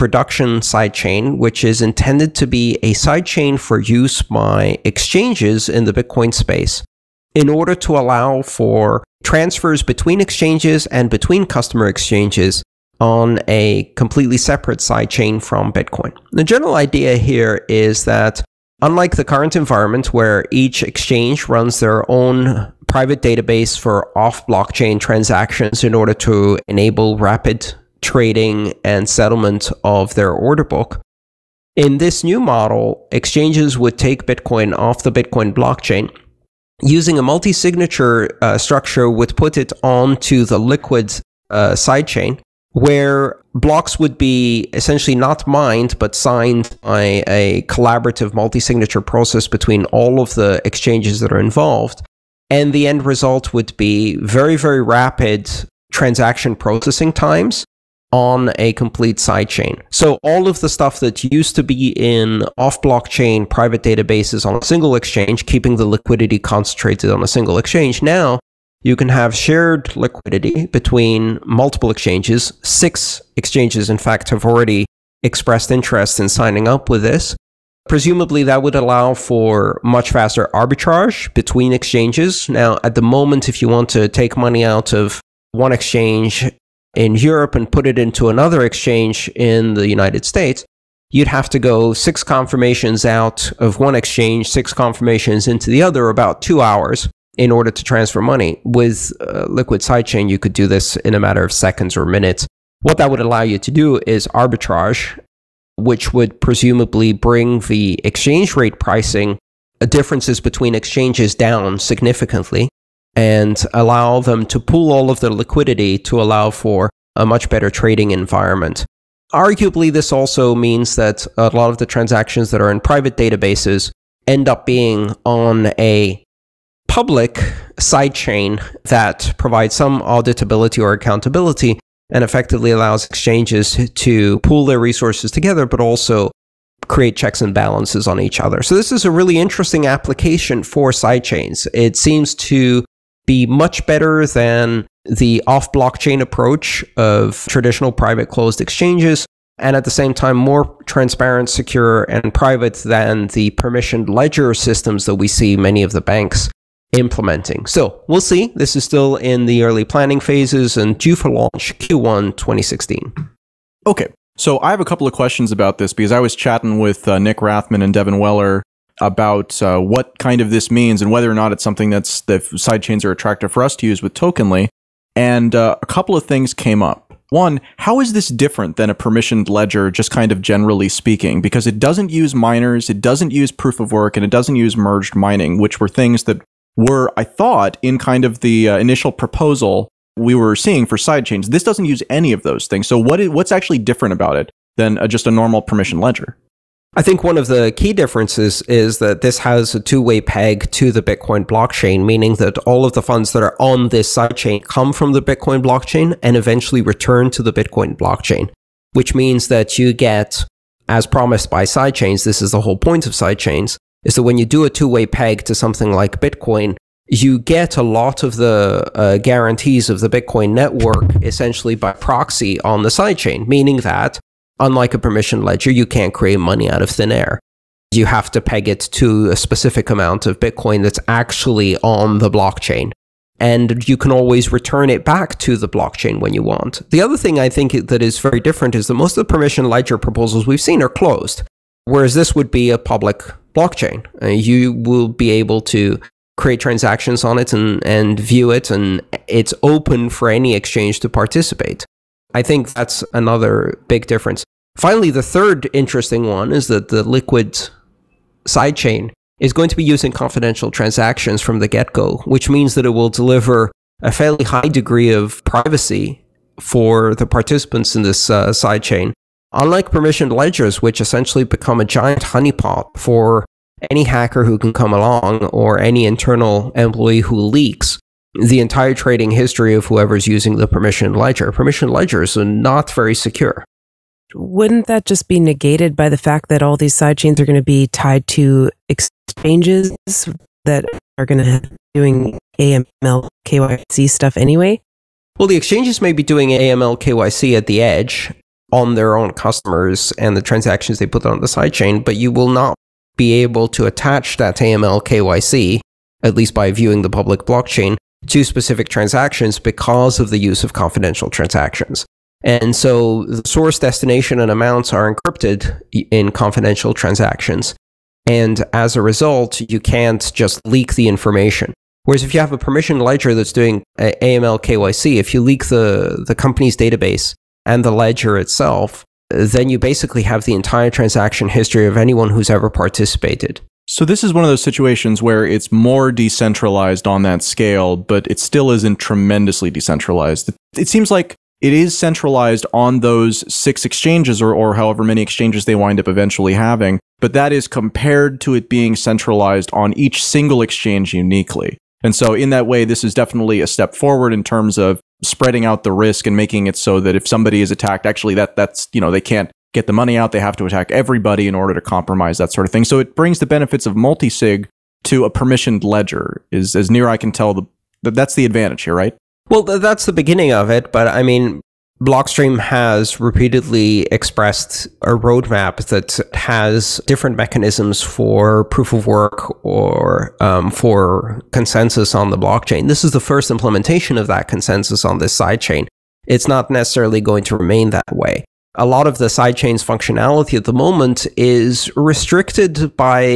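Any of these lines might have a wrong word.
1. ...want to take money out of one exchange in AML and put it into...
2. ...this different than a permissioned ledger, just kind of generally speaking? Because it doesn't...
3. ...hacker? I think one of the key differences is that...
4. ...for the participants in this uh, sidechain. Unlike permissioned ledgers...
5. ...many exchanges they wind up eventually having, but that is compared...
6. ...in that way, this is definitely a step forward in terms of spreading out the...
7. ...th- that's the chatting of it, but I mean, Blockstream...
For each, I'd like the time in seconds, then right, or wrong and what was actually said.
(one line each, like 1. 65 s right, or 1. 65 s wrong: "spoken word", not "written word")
1. 83 s wrong: "Europe", not "AML"
2. 178 s right
3. 196 s wrong: "ledger", not "hacker"
4. 266 s right
5. 345 s right
6. 352 s right
7. 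369 s wrong: "beginning", not "chatting".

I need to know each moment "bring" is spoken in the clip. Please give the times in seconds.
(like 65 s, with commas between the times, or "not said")
107 s, 363 s.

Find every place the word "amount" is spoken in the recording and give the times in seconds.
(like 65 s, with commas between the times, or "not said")
229 s, 314 s.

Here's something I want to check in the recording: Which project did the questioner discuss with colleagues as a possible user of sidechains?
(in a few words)
Tokenly.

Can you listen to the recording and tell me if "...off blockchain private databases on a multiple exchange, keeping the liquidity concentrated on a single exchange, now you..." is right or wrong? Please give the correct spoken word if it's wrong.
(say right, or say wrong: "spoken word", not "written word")
wrong: "single", not "multiple".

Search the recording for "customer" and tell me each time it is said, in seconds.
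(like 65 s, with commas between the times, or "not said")
11 s, 299 s.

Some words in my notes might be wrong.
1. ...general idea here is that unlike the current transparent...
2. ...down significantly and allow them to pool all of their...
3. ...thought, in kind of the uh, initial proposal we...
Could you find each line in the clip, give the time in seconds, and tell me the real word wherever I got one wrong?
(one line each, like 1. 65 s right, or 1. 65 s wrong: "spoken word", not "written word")
1. 16 s wrong: "environment", not "transparent"
2. 111 s right
3. 187 s right.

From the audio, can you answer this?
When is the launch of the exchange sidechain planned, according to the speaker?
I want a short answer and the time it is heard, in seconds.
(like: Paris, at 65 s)
Q1 2016, at 161 s.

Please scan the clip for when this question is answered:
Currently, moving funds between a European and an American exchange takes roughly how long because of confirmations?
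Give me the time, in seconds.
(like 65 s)
96 s.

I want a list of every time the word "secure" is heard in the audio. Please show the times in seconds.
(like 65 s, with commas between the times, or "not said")
151 s, 283 s.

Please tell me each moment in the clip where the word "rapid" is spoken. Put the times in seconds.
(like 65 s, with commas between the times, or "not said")
27 s, 54 s.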